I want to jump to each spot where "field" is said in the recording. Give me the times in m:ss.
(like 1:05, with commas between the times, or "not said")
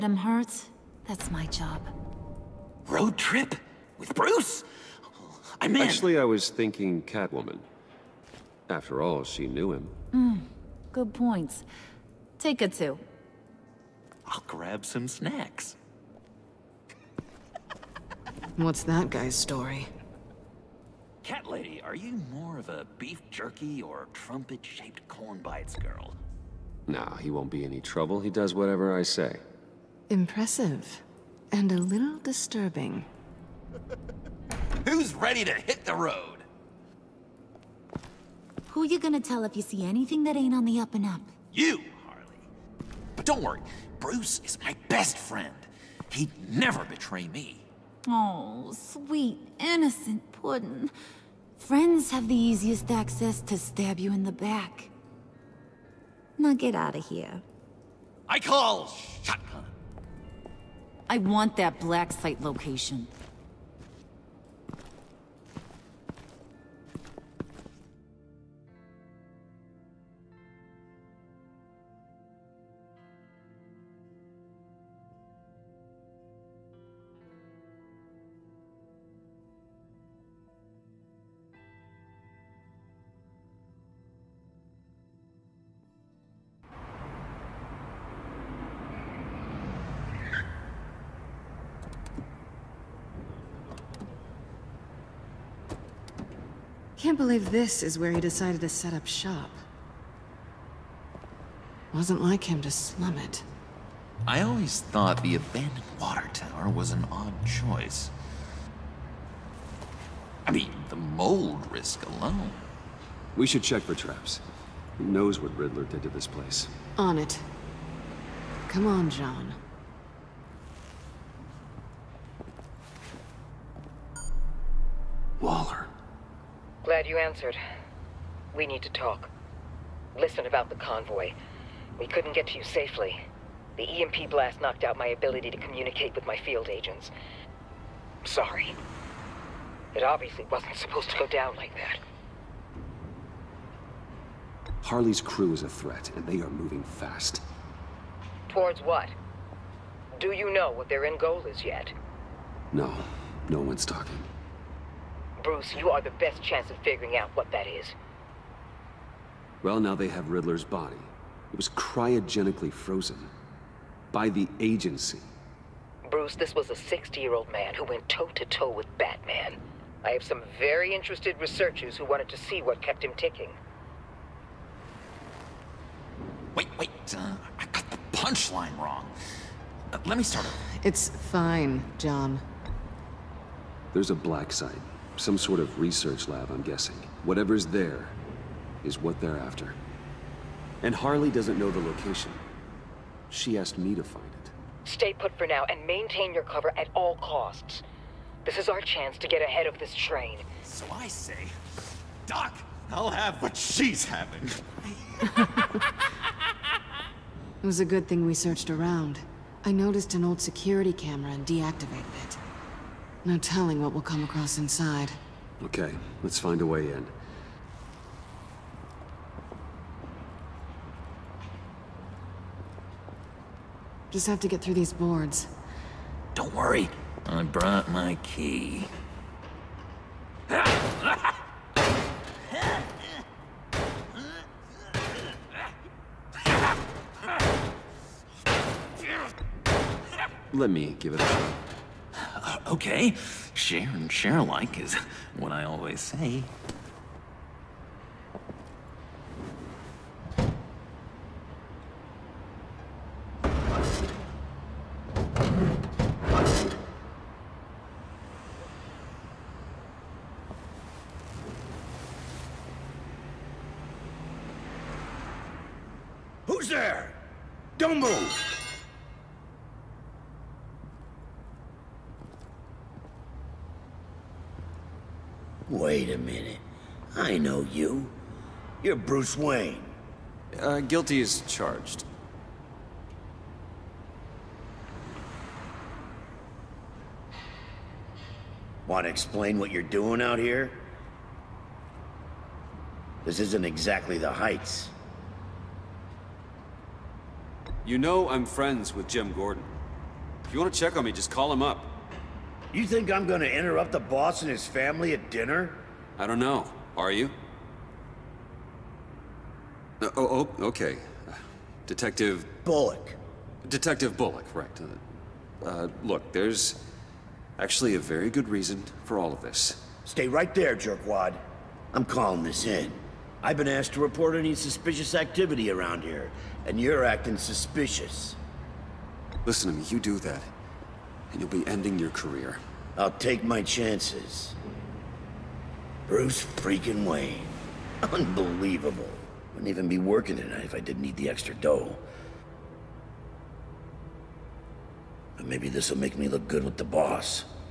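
2:16.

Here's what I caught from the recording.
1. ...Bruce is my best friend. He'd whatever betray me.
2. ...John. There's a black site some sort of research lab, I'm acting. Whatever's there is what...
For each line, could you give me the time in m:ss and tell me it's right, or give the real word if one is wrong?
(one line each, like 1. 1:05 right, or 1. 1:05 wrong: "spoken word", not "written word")
1. 0:43 wrong: "never", not "whatever"
2. 3:01 wrong: "guessing", not "acting".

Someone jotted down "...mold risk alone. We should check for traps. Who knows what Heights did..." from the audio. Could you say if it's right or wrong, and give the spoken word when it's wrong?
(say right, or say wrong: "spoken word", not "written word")
wrong: "Riddler", not "Heights".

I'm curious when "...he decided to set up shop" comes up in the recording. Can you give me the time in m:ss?
1:38.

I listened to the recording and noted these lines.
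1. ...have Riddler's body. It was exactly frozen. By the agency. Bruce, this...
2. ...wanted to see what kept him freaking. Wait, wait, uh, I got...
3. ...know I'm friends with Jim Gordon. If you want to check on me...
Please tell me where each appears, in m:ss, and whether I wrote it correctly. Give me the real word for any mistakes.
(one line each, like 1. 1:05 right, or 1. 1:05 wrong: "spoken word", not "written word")
1. 2:40 wrong: "cryogenically", not "exactly"
2. 2:52 wrong: "ticking", not "freaking"
3. 4:57 right.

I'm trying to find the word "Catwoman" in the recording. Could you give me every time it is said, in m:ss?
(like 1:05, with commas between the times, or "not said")
0:07.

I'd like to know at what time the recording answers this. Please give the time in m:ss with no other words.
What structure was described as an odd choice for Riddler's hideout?
1:45.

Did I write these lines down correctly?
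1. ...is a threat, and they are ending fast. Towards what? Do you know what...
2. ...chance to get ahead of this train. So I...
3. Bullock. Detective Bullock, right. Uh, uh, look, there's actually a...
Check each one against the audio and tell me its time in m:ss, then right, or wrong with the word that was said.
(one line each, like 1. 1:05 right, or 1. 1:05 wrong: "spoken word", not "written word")
1. 2:25 wrong: "moving", not "ending"
2. 3:18 right
3. 5:12 right.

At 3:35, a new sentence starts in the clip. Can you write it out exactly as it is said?
Okay, let's find a way in.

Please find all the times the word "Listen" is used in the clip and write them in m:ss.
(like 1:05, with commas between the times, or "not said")
2:10, 5:29.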